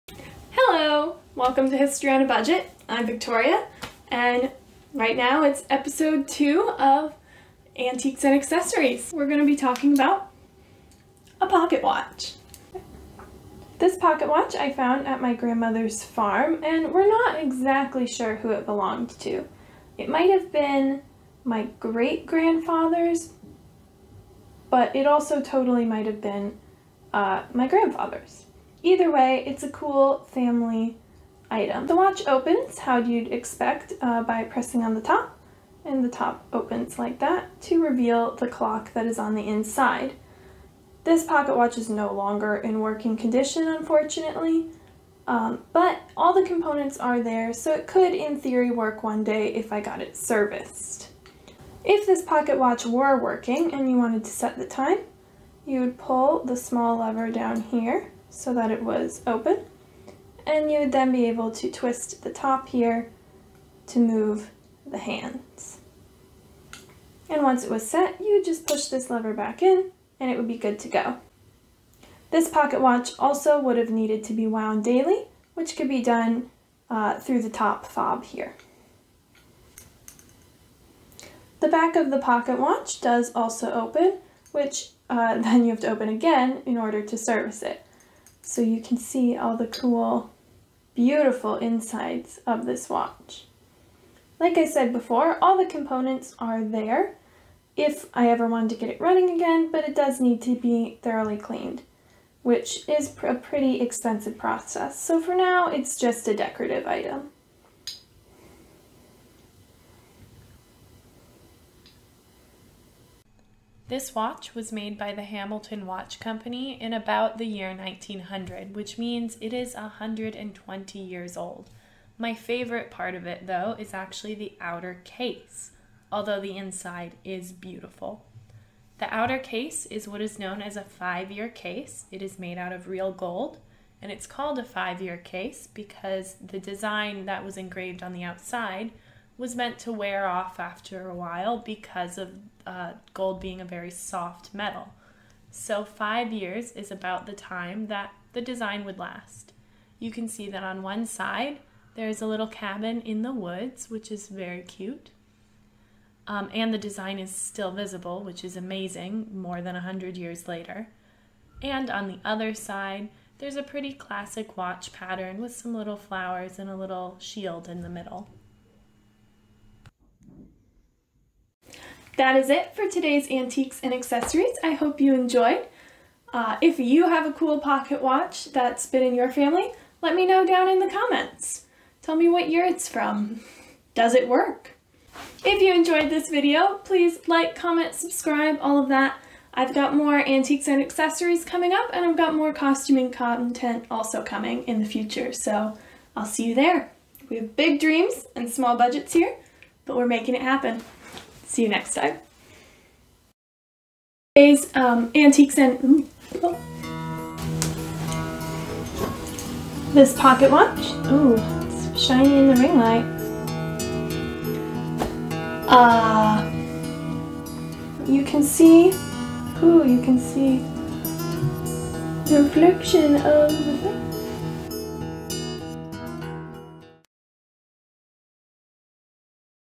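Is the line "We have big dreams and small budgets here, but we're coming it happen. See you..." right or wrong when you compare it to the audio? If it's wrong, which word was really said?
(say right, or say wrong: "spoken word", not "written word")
wrong: "making", not "coming".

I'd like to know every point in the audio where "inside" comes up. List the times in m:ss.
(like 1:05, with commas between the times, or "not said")
0:39, 1:31, 2:06.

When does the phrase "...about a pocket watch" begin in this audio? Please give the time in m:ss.
0:09.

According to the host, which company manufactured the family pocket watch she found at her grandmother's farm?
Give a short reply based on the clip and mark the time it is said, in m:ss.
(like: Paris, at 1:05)
Hamilton Watch Company, at 1:55.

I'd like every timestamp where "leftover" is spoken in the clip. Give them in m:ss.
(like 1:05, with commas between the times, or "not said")
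not said.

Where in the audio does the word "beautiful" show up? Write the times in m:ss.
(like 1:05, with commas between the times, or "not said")
1:30, 2:07.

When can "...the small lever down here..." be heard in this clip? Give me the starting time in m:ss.
0:56.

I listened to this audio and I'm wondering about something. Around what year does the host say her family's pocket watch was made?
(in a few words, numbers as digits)
1900.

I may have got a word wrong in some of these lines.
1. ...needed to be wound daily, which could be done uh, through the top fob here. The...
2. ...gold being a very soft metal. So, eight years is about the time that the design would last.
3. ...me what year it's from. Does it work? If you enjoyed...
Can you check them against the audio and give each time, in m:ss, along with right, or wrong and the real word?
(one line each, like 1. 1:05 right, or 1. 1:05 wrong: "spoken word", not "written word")
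1. 1:13 right
2. 2:23 wrong: "five", not "eight"
3. 3:02 right.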